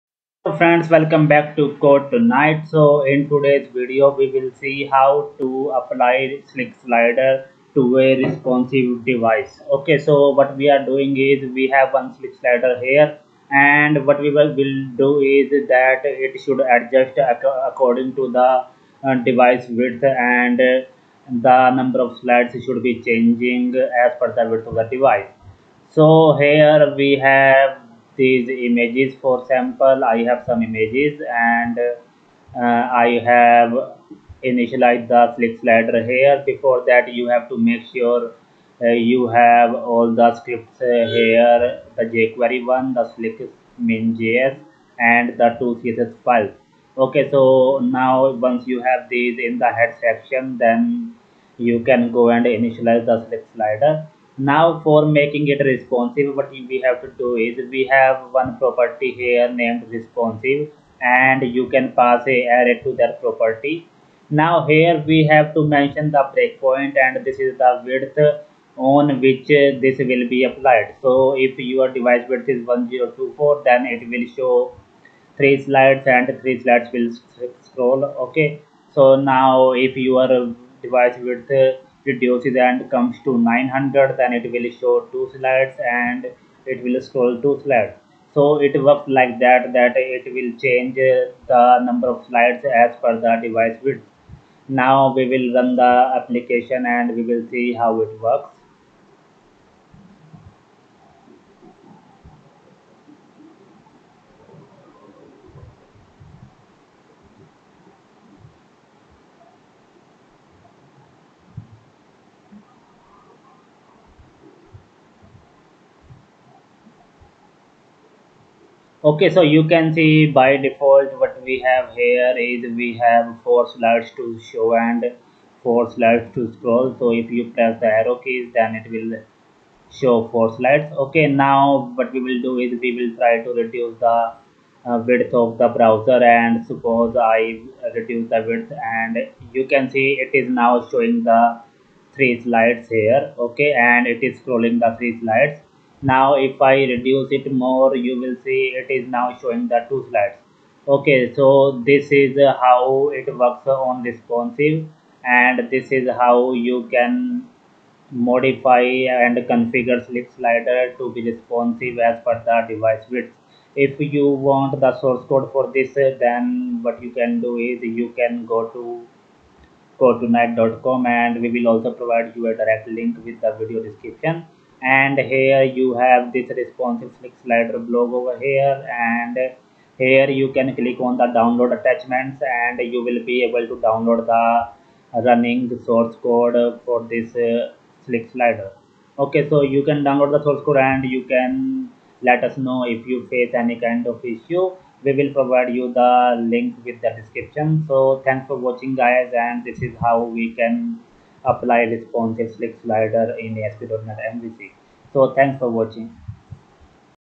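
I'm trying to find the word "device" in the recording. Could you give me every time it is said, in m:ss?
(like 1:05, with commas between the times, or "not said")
0:09, 0:19, 0:24, 1:11, 1:20, 1:33, 2:42.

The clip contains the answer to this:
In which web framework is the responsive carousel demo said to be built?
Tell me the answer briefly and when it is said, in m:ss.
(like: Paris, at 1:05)
ASP.NET MVC, at 3:23.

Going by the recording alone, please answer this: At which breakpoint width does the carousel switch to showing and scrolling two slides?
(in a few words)
900.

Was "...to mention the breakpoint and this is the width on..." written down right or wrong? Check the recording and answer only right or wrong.
right.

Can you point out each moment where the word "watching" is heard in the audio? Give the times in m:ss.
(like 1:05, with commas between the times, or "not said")
3:18, 3:25.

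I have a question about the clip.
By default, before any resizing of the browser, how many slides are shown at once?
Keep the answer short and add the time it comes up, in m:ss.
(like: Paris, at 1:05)
4, at 2:03.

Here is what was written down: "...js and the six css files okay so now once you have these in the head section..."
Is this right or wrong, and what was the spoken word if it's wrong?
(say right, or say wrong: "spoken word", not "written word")
wrong: "two", not "six".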